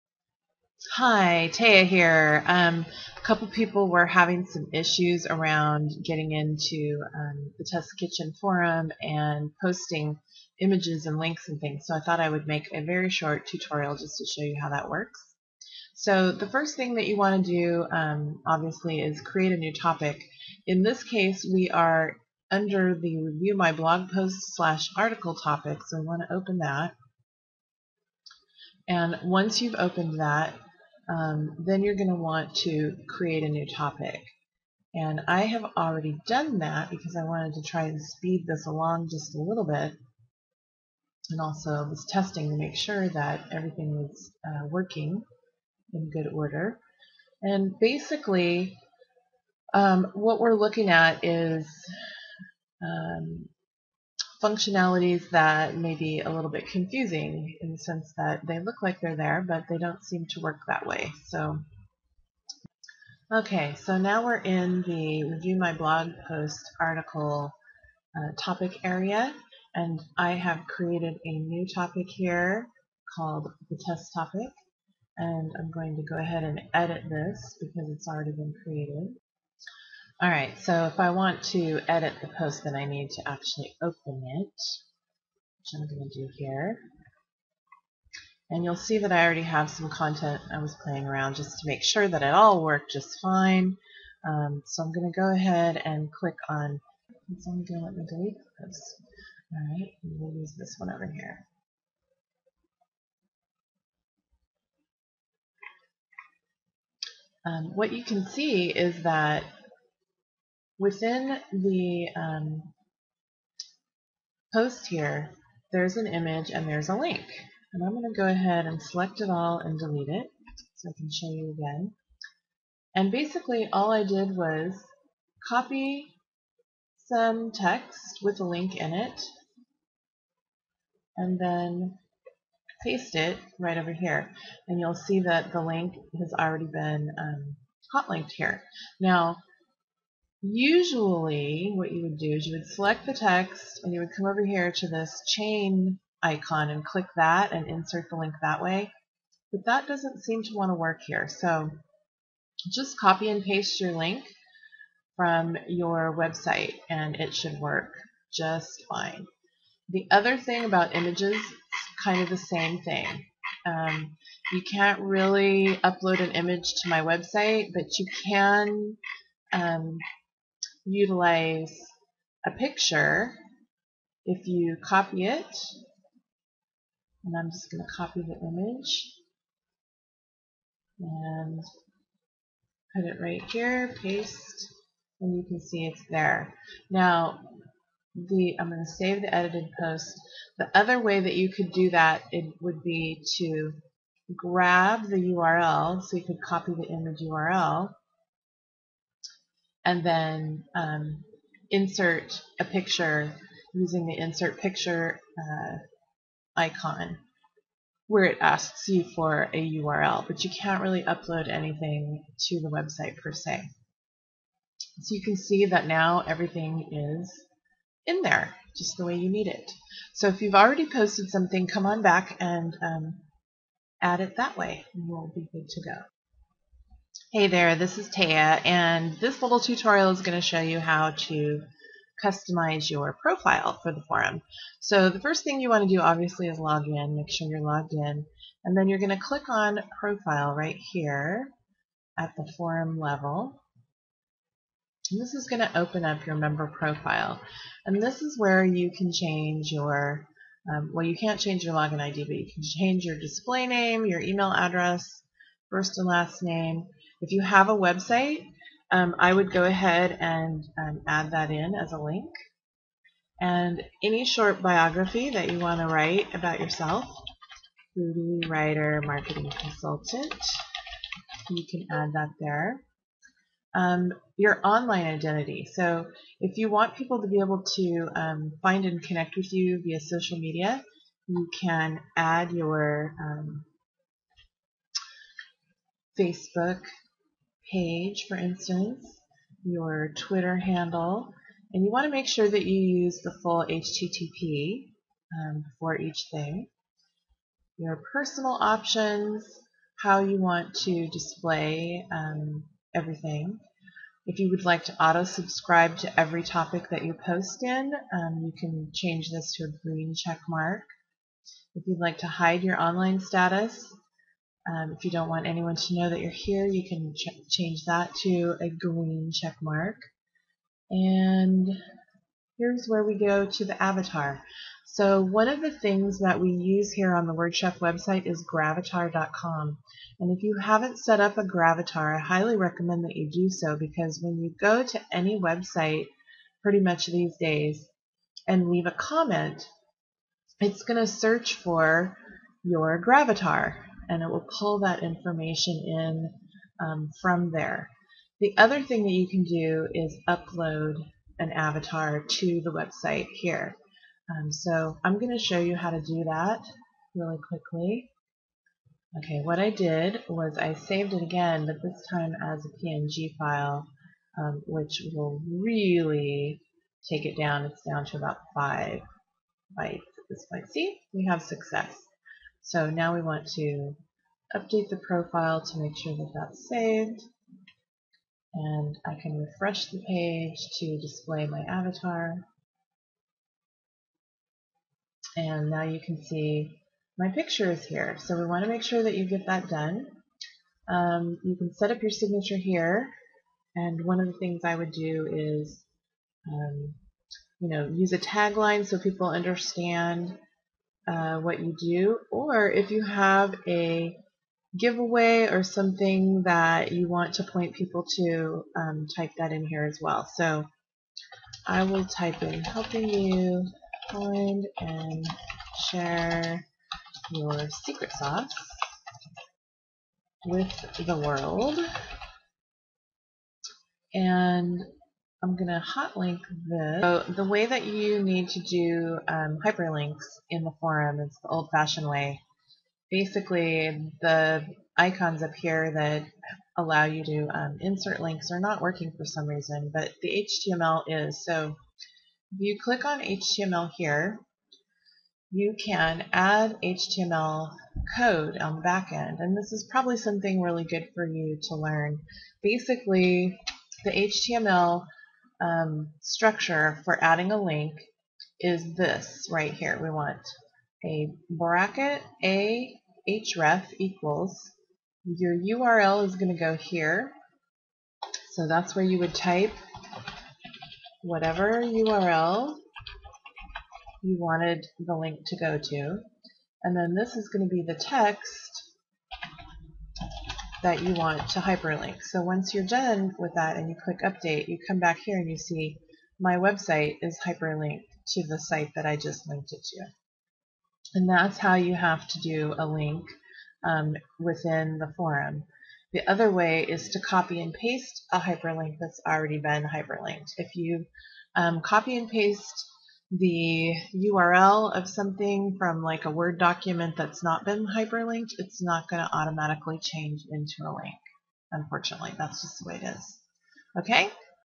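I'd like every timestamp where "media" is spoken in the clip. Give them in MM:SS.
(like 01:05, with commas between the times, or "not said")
04:40.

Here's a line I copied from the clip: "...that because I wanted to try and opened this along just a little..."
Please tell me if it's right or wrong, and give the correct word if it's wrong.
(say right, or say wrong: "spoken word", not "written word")
wrong: "speed", not "opened".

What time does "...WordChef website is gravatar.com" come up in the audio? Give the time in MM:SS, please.
05:27.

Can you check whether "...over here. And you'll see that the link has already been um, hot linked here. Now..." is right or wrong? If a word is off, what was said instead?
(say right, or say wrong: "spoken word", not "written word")
right.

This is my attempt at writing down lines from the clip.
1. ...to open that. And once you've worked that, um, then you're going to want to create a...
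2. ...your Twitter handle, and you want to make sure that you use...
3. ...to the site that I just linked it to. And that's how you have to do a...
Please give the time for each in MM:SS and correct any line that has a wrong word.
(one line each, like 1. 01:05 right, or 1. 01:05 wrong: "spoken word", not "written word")
1. 00:26 wrong: "opened", not "worked"
2. 04:49 right
3. 08:08 right.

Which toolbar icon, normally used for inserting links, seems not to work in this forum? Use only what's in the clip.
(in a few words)
chain icon.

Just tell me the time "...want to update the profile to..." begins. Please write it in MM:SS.
06:13.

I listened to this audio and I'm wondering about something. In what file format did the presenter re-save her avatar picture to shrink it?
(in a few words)
PNG.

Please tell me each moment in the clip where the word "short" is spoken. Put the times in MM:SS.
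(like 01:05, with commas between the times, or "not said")
00:13, 04:24.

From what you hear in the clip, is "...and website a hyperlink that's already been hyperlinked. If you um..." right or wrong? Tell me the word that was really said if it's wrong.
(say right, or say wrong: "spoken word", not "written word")
wrong: "paste", not "website".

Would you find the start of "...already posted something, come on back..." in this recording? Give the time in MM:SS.
03:40.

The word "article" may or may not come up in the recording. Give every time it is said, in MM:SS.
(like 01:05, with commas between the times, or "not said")
00:24, 01:06.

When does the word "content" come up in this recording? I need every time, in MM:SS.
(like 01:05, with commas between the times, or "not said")
01:29.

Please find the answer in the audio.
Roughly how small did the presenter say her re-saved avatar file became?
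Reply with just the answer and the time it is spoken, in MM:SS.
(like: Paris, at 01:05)
5 bytes, at 06:08.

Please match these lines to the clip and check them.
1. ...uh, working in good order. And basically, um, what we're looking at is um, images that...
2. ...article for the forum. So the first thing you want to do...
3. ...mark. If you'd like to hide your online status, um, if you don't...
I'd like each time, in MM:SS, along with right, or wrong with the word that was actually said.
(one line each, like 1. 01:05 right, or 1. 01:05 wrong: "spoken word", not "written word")
1. 00:44 wrong: "functionalities", not "images"
2. 03:53 wrong: "profile", not "article"
3. 05:10 right.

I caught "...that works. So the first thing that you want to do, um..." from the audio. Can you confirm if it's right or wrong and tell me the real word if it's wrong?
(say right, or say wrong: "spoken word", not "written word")
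right.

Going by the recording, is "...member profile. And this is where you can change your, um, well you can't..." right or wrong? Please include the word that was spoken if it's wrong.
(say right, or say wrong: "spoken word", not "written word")
right.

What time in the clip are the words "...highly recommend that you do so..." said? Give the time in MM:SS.
05:32.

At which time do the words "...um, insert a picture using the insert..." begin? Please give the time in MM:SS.
03:20.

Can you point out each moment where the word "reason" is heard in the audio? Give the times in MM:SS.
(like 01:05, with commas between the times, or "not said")
07:19.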